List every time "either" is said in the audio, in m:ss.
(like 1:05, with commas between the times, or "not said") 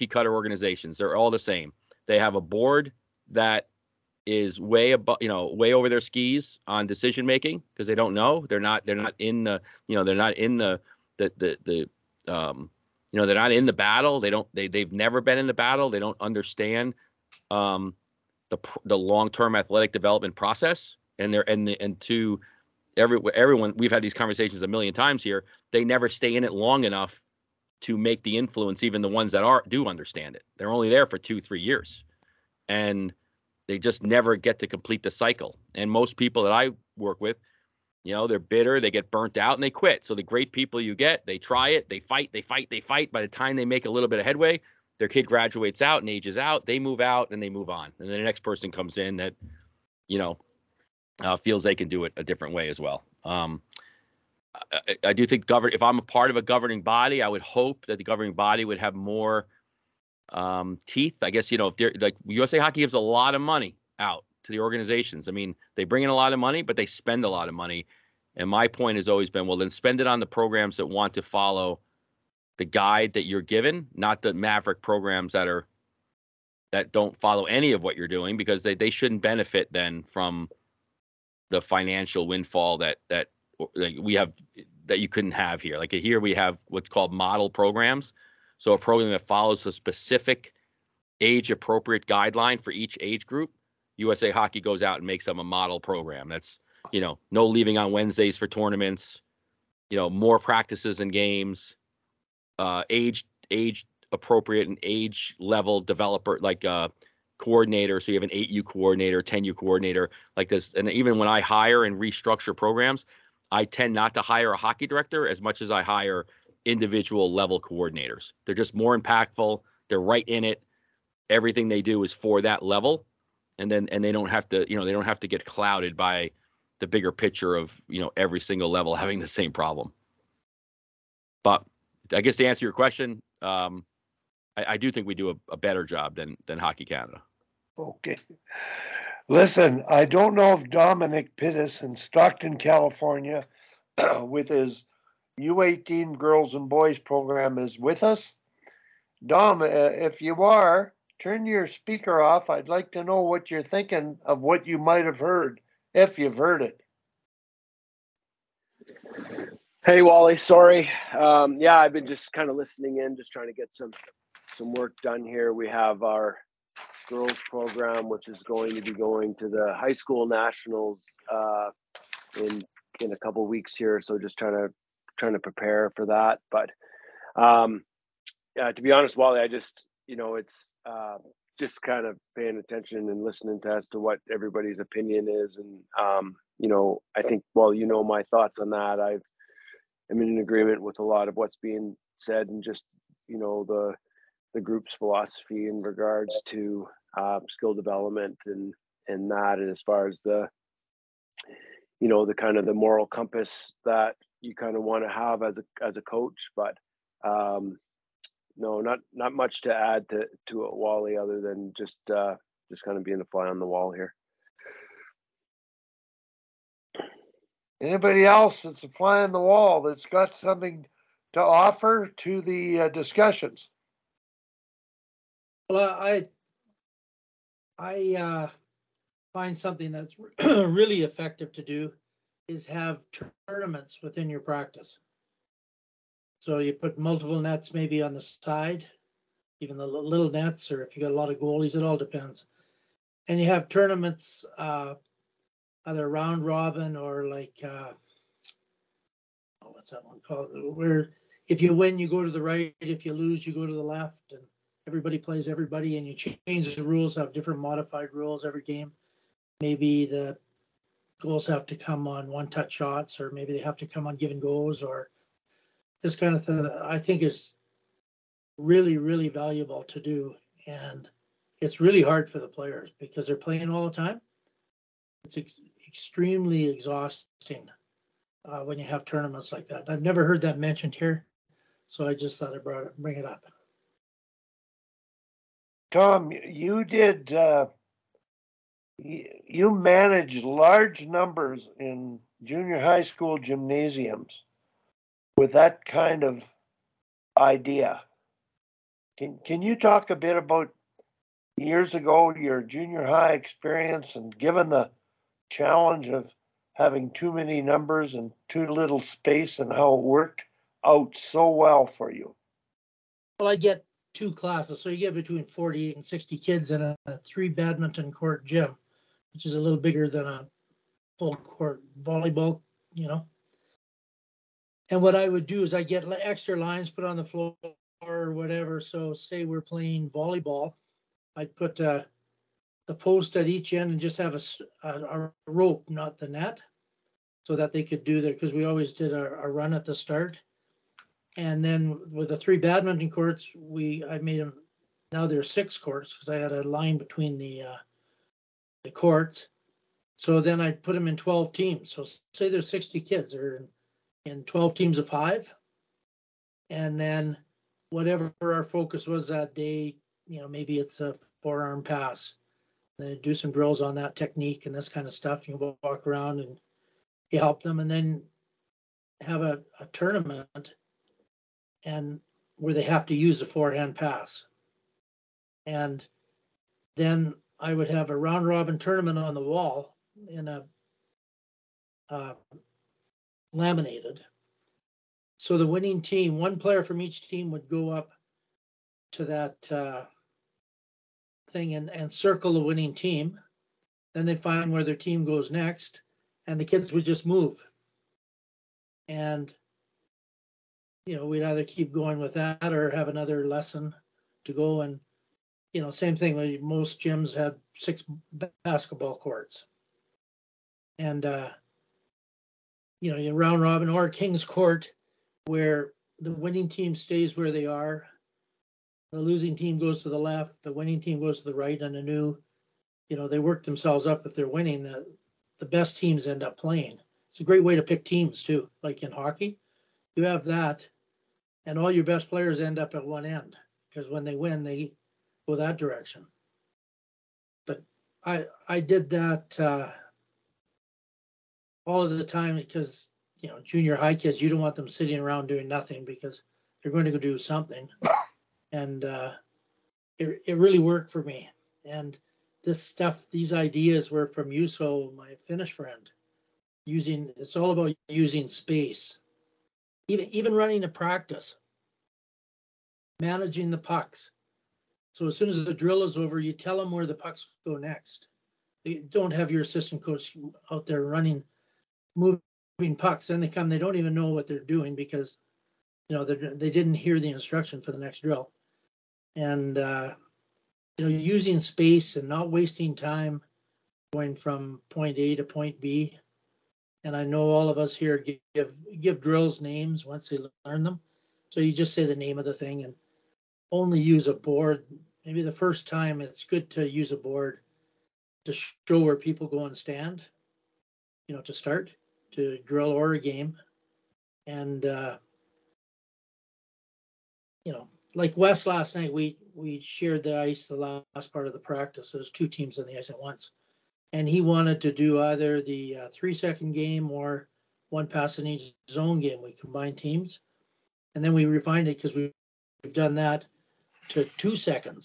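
4:05, 6:41, 8:35.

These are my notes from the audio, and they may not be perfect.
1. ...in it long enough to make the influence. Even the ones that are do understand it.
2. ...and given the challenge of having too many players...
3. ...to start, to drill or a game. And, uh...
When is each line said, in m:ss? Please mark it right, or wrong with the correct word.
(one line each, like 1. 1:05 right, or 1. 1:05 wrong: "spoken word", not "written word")
1. 0:26 right
2. 5:04 wrong: "numbers", not "players"
3. 8:21 right.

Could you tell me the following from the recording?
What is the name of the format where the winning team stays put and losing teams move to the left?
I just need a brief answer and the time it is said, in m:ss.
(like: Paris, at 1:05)
King's Court, at 6:54.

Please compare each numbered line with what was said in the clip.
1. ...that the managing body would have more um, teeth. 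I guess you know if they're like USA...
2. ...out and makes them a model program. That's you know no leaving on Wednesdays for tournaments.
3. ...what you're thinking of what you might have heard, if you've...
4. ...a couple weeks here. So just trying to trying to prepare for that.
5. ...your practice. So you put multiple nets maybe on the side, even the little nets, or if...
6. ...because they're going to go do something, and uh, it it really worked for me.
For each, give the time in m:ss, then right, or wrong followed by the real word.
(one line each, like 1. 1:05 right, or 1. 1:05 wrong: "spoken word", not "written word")
1. 0:57 wrong: "governing", not "managing"
2. 1:34 right
3. 2:33 right
4. 2:53 right
5. 3:54 right
6. 7:26 right.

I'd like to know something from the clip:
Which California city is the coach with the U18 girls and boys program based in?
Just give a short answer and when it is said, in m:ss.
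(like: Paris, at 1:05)
Stockton, at 2:21.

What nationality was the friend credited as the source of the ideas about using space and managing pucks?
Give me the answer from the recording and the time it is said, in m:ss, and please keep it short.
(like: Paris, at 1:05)
Finnish, at 7:35.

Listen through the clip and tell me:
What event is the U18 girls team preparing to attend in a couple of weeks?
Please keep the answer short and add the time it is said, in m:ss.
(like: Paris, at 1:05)
high school nationals, at 2:49.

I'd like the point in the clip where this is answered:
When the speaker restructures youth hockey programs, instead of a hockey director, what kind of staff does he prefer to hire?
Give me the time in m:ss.
1:56.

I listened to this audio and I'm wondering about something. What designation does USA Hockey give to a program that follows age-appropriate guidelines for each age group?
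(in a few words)
model programs.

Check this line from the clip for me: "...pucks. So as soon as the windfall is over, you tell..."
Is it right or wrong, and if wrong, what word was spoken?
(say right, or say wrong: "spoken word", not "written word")
wrong: "drill", not "windfall".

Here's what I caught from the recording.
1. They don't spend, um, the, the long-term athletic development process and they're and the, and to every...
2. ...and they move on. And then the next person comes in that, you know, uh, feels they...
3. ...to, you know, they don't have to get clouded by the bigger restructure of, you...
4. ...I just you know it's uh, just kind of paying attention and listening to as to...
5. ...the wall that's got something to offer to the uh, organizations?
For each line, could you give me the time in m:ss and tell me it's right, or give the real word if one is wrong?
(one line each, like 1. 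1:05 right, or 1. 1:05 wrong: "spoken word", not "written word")
1. 0:15 wrong: "understand", not "spend"
2. 0:47 right
3. 2:04 wrong: "picture", not "restructure"
4. 2:59 right
5. 3:39 wrong: "discussions", not "organizations".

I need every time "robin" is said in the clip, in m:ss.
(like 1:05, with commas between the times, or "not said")
4:06, 6:18, 6:53.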